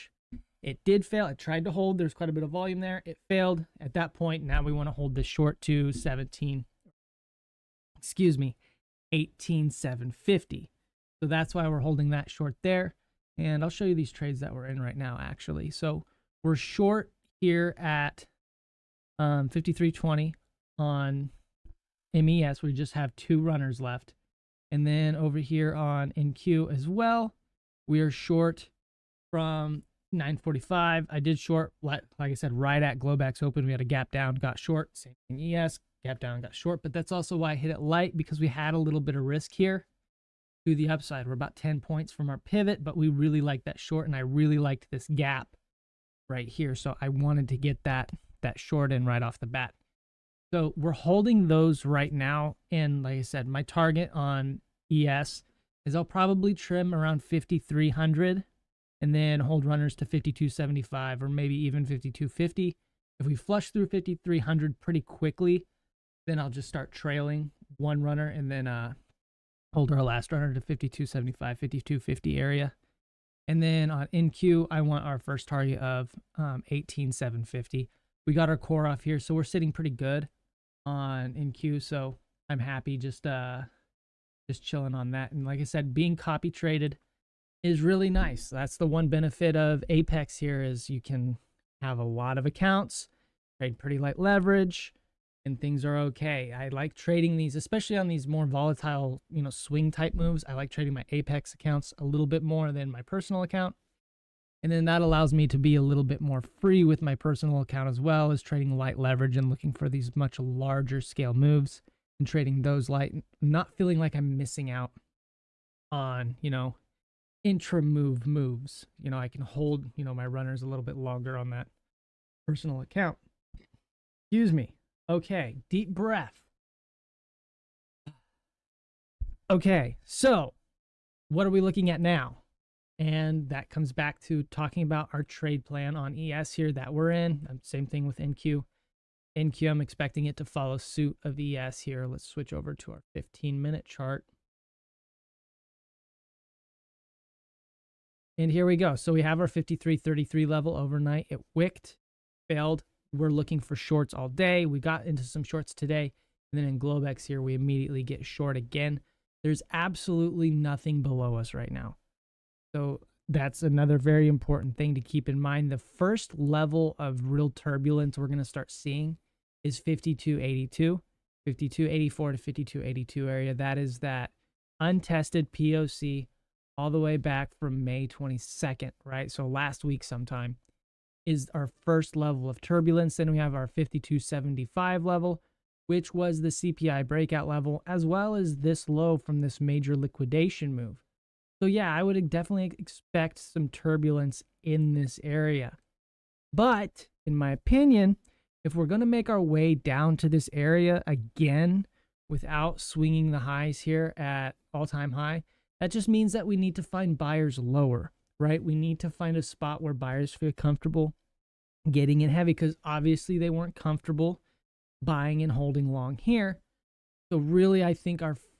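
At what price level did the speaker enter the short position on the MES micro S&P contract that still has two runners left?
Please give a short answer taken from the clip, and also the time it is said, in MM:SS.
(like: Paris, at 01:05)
5320, at 00:19.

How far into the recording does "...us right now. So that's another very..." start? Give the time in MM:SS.
02:41.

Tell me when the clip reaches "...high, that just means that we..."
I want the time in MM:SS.
03:25.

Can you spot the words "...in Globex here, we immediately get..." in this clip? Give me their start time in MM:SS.
02:36.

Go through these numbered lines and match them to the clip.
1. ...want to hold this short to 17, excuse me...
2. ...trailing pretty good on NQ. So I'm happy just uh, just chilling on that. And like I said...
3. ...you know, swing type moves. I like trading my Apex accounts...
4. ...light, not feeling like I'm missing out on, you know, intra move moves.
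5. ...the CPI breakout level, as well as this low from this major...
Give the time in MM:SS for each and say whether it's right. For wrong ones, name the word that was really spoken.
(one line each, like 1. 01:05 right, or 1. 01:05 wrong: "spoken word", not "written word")
1. 00:04 right
2. 01:19 wrong: "sitting", not "trailing"
3. 01:39 right
4. 01:52 right
5. 03:06 right.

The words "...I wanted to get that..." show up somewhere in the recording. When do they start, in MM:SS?
00:47.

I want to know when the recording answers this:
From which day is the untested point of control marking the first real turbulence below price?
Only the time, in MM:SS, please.
02:57.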